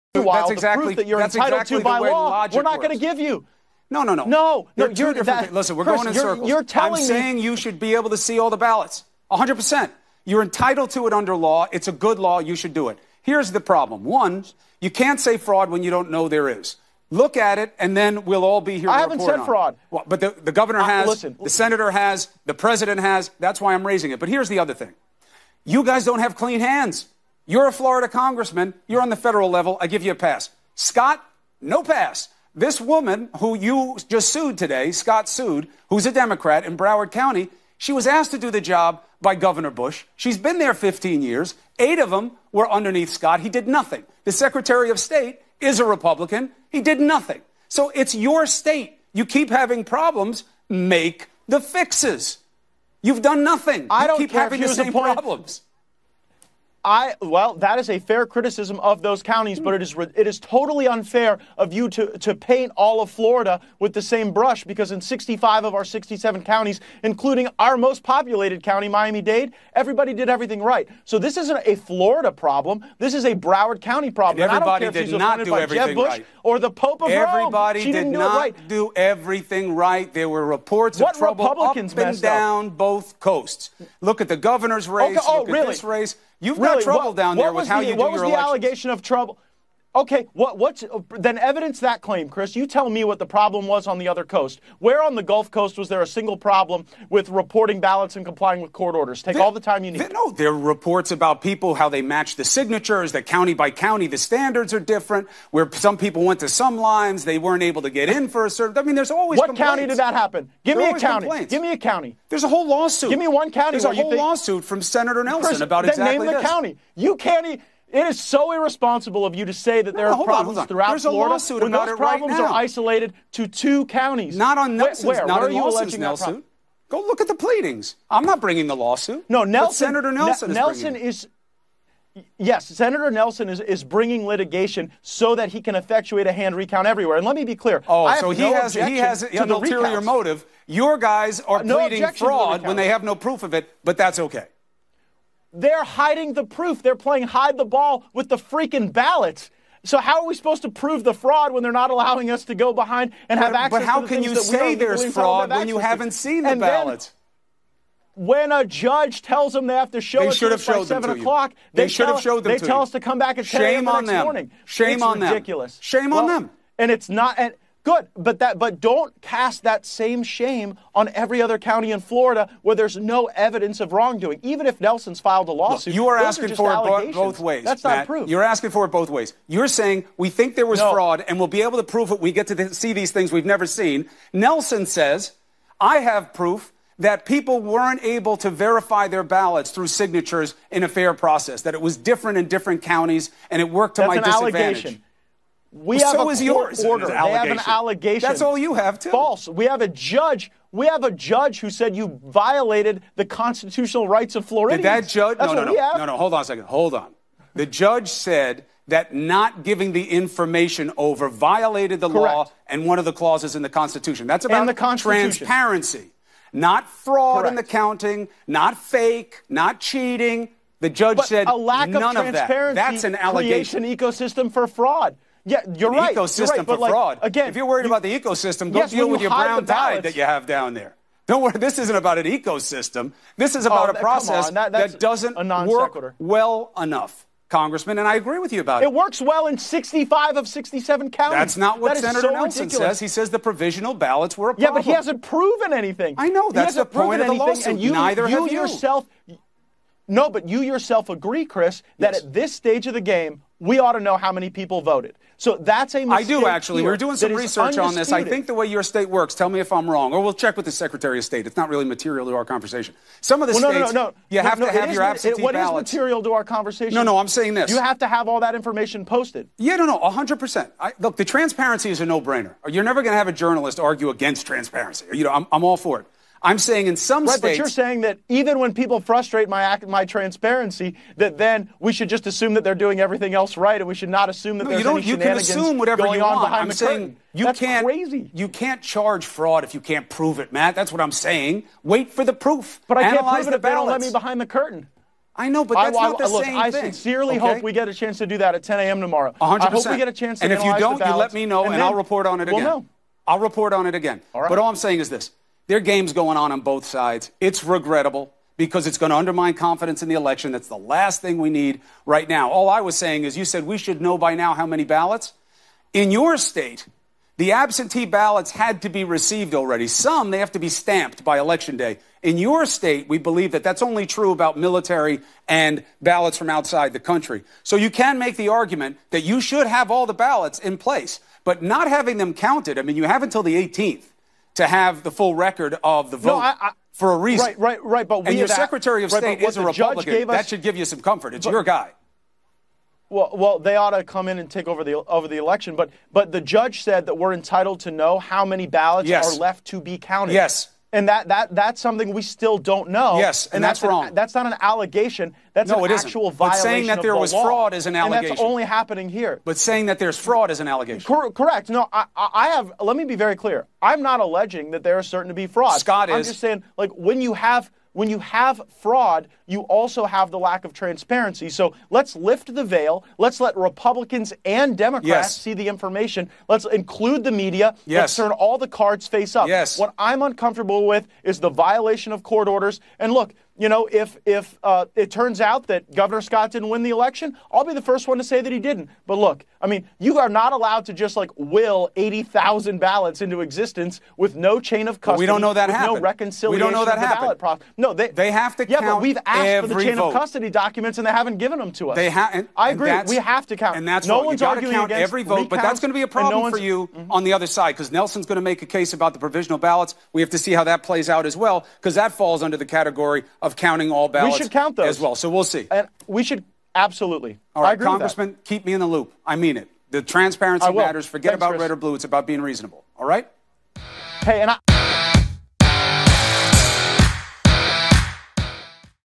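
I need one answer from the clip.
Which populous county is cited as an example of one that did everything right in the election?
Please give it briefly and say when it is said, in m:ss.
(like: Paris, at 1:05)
Miami-Dade, at 1:08.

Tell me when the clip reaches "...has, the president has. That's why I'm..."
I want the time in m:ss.
0:21.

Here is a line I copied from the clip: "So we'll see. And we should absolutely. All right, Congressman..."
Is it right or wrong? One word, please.
right.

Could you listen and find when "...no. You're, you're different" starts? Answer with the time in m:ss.
0:04.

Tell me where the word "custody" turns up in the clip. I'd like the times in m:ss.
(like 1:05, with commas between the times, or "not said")
6:34, 6:40.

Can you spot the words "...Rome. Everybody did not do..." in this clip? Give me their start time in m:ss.
1:17.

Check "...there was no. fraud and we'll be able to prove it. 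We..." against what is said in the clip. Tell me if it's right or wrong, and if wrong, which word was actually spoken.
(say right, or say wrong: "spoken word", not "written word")
right.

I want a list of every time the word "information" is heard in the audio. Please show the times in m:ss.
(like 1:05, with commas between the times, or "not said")
3:30, 4:28, 6:15.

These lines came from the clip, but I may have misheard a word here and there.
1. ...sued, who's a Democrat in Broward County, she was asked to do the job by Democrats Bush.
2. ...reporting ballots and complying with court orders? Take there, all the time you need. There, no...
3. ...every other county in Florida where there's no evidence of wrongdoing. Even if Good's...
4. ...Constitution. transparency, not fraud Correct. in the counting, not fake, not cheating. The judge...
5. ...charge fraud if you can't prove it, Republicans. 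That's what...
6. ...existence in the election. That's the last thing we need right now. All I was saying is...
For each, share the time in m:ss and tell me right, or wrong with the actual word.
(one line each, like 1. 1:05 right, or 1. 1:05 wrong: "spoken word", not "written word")
1. 0:35 wrong: "Governor", not "Democrats"
2. 1:37 right
3. 2:51 wrong: "Nelson", not "Good"
4. 3:34 right
5. 4:48 wrong: "Matt", not "Republicans"
6. 5:09 wrong: "confidence", not "existence".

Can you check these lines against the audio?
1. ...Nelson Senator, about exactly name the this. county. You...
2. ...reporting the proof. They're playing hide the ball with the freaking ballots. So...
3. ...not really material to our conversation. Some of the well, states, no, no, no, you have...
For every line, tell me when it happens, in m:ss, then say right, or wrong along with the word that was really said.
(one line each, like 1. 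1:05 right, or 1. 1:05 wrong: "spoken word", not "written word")
1. 1:55 wrong: "Chris", not "Senator"
2. 2:25 wrong: "hiding", not "reporting"
3. 4:21 right.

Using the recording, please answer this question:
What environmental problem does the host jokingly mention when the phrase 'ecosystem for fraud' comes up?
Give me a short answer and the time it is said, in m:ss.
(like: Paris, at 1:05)
brown tide, at 3:49.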